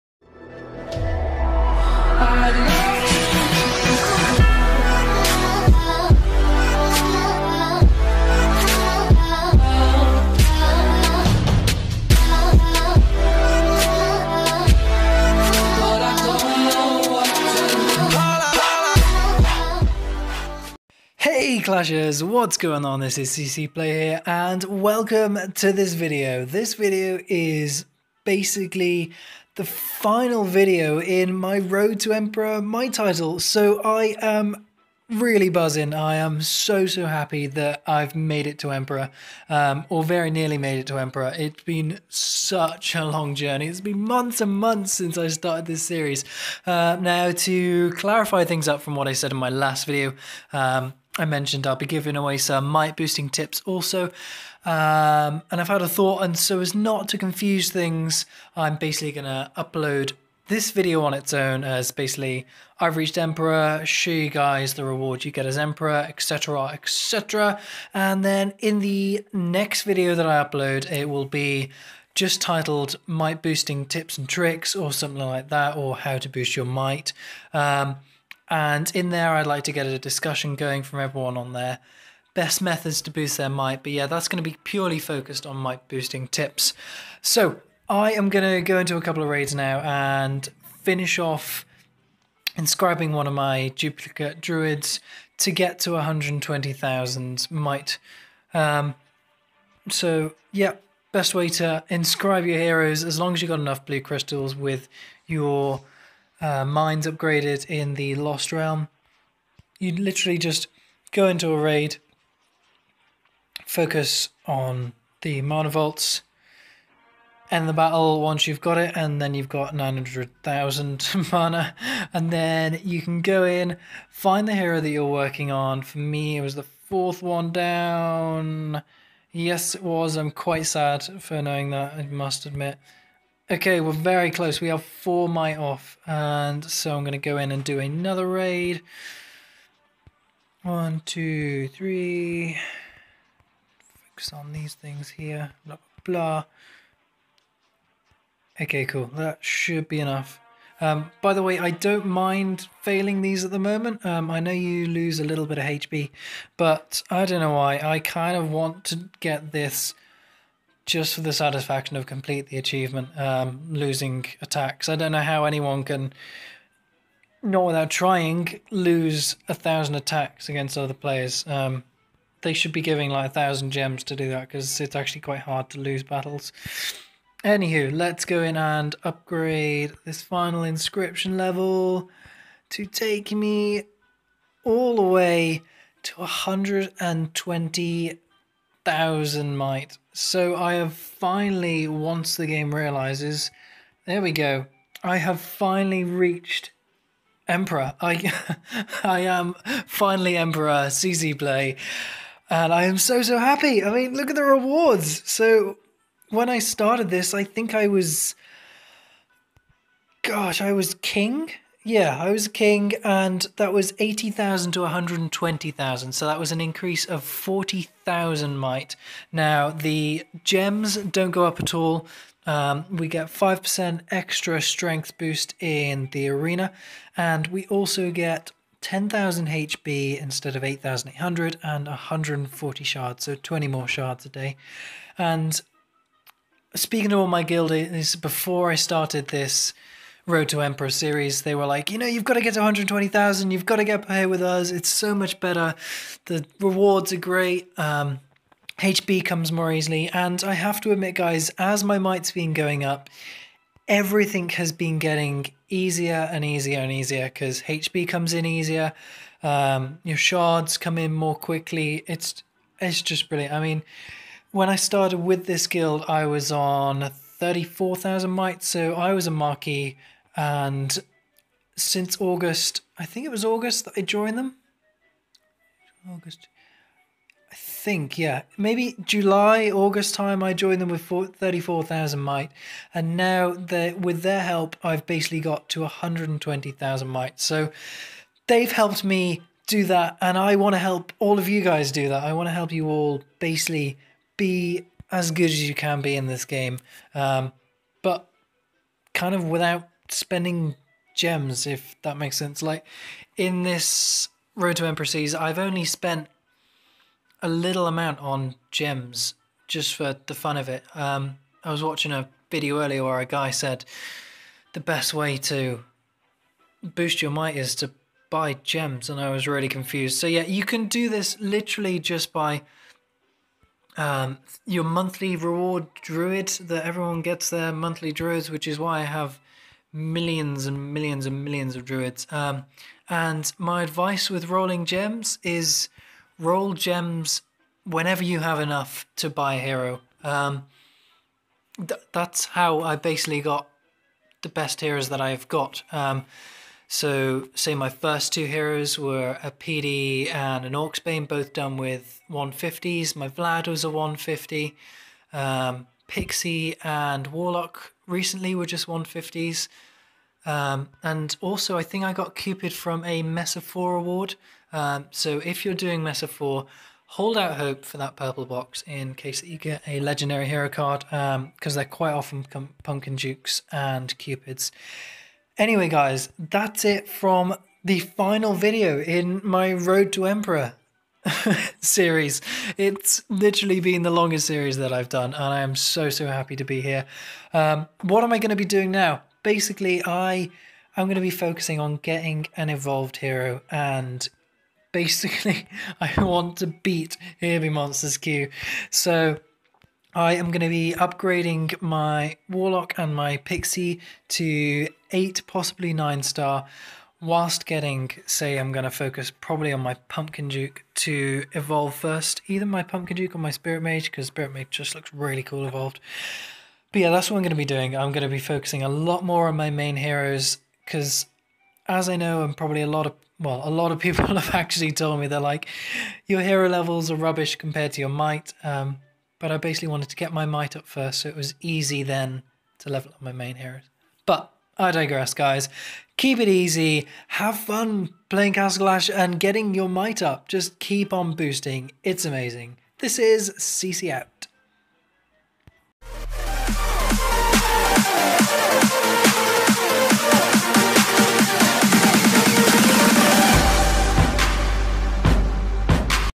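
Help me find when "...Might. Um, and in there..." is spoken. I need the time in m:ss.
1:16.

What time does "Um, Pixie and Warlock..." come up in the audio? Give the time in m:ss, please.
5:55.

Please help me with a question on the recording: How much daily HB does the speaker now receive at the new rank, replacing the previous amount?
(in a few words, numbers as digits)
10,000.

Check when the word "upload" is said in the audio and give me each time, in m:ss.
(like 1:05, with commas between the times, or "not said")
0:59, 1:10.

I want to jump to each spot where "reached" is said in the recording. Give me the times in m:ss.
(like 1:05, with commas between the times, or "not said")
1:02, 3:16.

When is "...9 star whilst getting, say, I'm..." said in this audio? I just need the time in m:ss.
6:45.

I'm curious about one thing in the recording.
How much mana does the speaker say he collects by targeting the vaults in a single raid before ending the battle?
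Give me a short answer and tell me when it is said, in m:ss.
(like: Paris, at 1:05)
900,000, at 1:59.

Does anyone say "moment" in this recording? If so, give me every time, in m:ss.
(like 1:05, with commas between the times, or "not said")
2:33.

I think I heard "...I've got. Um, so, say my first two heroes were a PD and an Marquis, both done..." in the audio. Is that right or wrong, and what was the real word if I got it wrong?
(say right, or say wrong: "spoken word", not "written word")
wrong: "Orcsbane", not "Marquis".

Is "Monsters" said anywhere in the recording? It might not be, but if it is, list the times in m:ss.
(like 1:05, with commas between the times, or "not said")
6:37.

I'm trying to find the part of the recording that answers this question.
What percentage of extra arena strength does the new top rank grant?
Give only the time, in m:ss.
3:43.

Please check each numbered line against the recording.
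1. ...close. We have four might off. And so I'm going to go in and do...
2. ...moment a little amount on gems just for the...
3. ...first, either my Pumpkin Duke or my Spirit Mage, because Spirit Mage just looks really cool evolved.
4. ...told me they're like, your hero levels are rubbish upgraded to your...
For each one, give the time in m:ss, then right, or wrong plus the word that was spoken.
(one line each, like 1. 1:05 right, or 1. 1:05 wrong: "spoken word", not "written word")
1. 2:14 right
2. 5:05 wrong: "spent", not "moment"
3. 6:51 right
4. 7:04 wrong: "compared", not "upgraded".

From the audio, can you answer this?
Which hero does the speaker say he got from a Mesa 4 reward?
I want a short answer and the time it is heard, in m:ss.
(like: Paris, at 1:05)
Cupid, at 6:02.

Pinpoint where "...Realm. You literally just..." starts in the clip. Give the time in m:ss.
1:48.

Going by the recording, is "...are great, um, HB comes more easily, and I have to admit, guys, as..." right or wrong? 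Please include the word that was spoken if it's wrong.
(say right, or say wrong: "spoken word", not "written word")
right.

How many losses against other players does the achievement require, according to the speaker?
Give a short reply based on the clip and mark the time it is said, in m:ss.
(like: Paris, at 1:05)
1,000, at 2:49.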